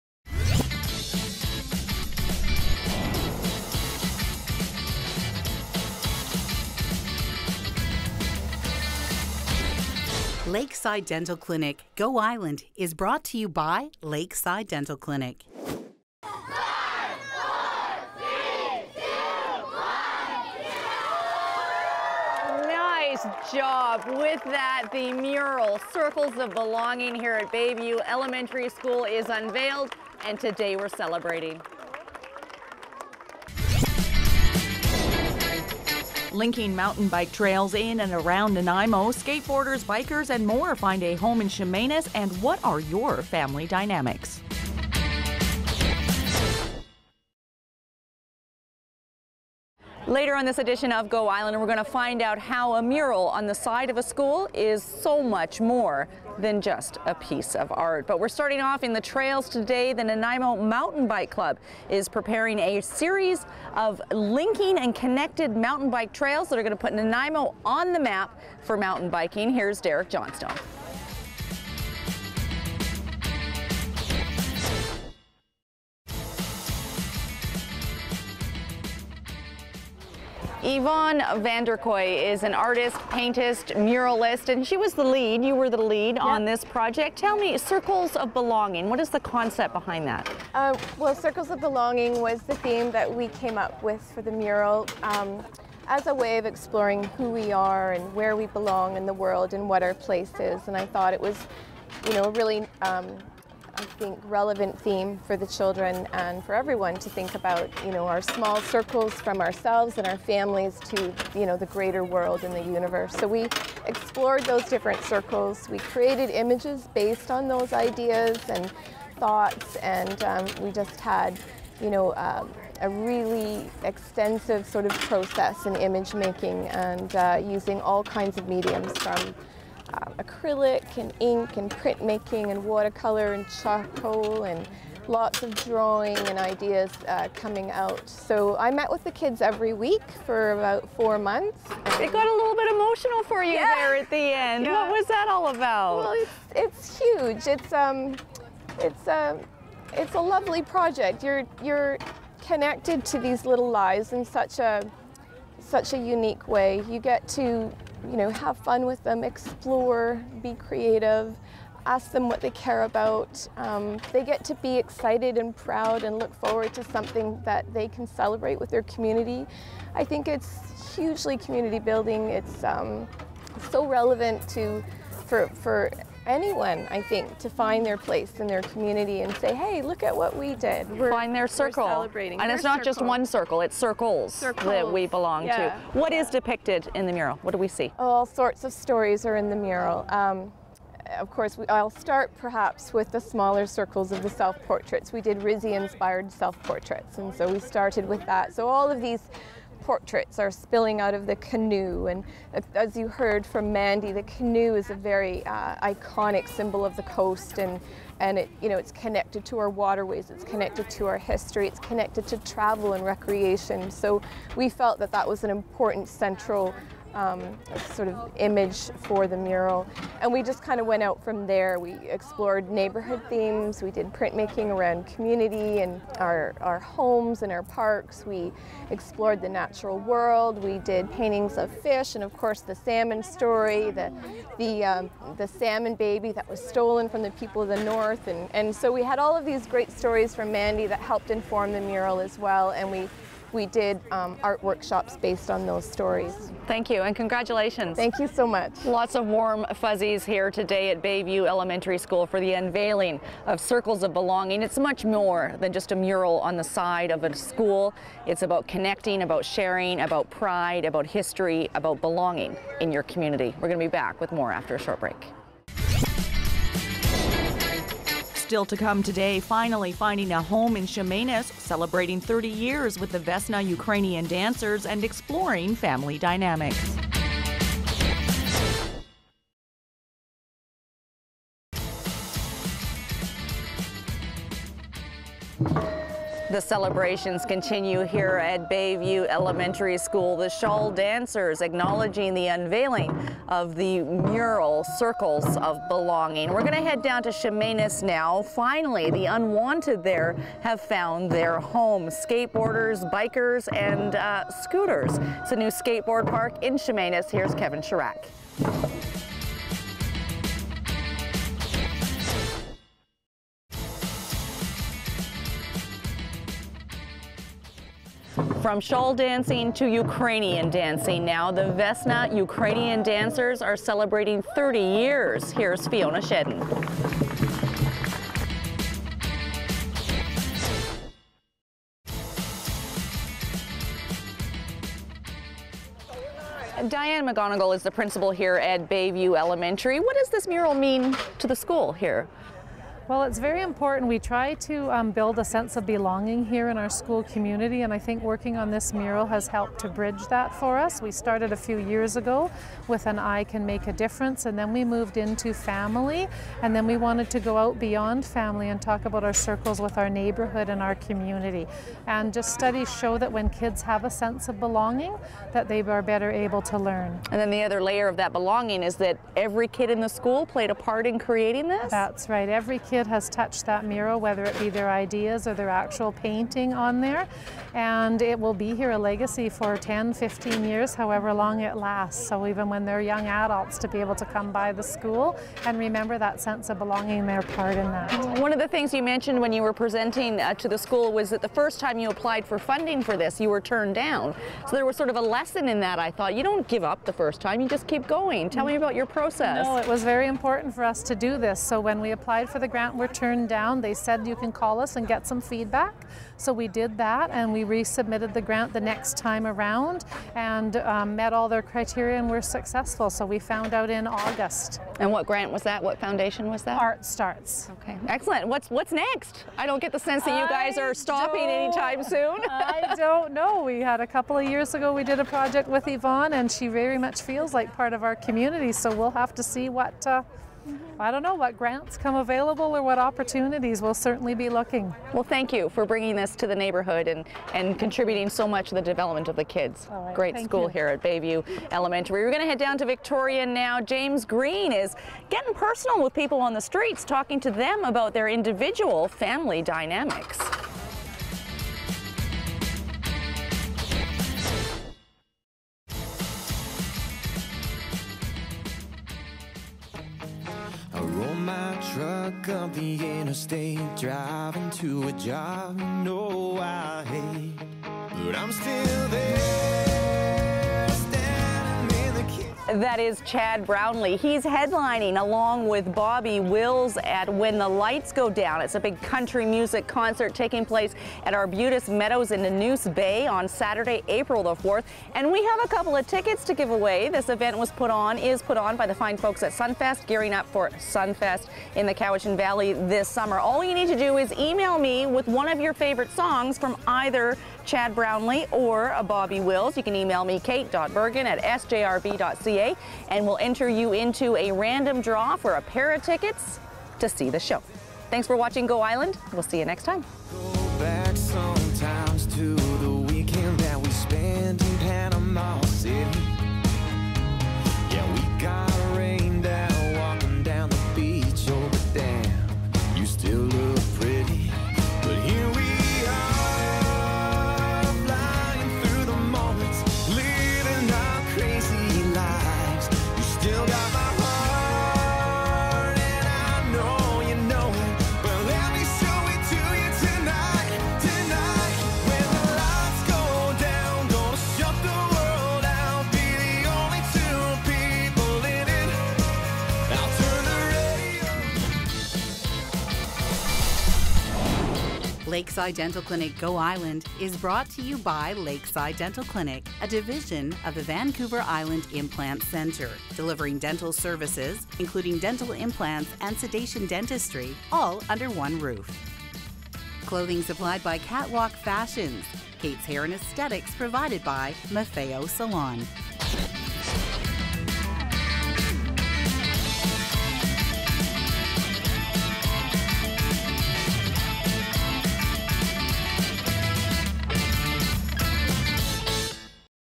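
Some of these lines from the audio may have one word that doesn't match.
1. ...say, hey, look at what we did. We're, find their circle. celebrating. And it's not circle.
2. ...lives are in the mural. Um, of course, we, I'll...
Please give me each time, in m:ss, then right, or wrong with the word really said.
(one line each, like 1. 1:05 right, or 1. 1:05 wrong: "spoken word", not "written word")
1. 2:59 right
2. 3:08 wrong: "stories", not "lives".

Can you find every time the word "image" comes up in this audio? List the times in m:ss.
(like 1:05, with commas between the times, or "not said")
1:56, 2:05, 3:38.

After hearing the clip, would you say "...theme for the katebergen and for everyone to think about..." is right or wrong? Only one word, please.
wrong.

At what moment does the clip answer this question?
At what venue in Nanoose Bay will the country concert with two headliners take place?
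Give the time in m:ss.
8:01.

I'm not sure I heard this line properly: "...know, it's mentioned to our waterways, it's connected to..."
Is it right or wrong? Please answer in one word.
wrong.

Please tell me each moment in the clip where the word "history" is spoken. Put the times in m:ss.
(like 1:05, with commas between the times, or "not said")
3:31, 4:21.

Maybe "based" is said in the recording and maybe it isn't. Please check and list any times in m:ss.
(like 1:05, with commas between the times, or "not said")
1:56, 4:05.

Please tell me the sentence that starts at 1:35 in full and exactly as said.
Um, as a way of exploring who we are and where we belong in the world and what our place is.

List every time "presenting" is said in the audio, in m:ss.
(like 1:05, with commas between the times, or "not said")
6:29.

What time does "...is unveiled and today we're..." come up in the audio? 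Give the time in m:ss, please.
0:29.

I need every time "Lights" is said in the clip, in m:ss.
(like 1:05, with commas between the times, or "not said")
7:57.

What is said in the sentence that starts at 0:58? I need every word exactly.
But we're starting off in the trails today.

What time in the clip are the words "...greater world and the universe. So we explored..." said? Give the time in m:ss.
1:51.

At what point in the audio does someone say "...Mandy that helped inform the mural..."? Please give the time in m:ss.
4:00.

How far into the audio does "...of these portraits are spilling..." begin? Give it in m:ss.
3:18.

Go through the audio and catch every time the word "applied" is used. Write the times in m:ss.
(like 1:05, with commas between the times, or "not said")
6:32, 6:42.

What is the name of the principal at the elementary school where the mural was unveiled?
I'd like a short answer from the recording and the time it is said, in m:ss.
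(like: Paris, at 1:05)
Diane McGonigal, at 5:36.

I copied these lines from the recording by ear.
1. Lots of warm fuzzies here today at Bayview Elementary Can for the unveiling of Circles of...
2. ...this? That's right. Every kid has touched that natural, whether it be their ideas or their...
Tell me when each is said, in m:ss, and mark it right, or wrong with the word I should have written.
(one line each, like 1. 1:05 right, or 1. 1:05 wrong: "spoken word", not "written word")
1. 4:08 wrong: "School", not "Can"
2. 6:11 wrong: "mural", not "natural".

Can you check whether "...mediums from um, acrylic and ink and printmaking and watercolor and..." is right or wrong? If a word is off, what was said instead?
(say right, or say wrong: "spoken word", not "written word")
right.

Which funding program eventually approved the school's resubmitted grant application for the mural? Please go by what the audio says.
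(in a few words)
Art Starts.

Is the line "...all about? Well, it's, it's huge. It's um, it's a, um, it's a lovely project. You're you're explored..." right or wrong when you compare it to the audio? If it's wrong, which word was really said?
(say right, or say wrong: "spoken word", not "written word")
wrong: "connected", not "explored".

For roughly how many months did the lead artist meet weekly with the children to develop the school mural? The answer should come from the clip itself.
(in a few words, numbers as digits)
4.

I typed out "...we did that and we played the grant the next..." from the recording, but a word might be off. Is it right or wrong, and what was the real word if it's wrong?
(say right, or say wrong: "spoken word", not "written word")
wrong: "resubmitted", not "played".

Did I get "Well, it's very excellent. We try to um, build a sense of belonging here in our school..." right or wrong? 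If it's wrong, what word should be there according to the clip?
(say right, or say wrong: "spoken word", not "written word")
wrong: "important", not "excellent".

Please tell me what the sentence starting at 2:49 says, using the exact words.
I think it's hugely community building.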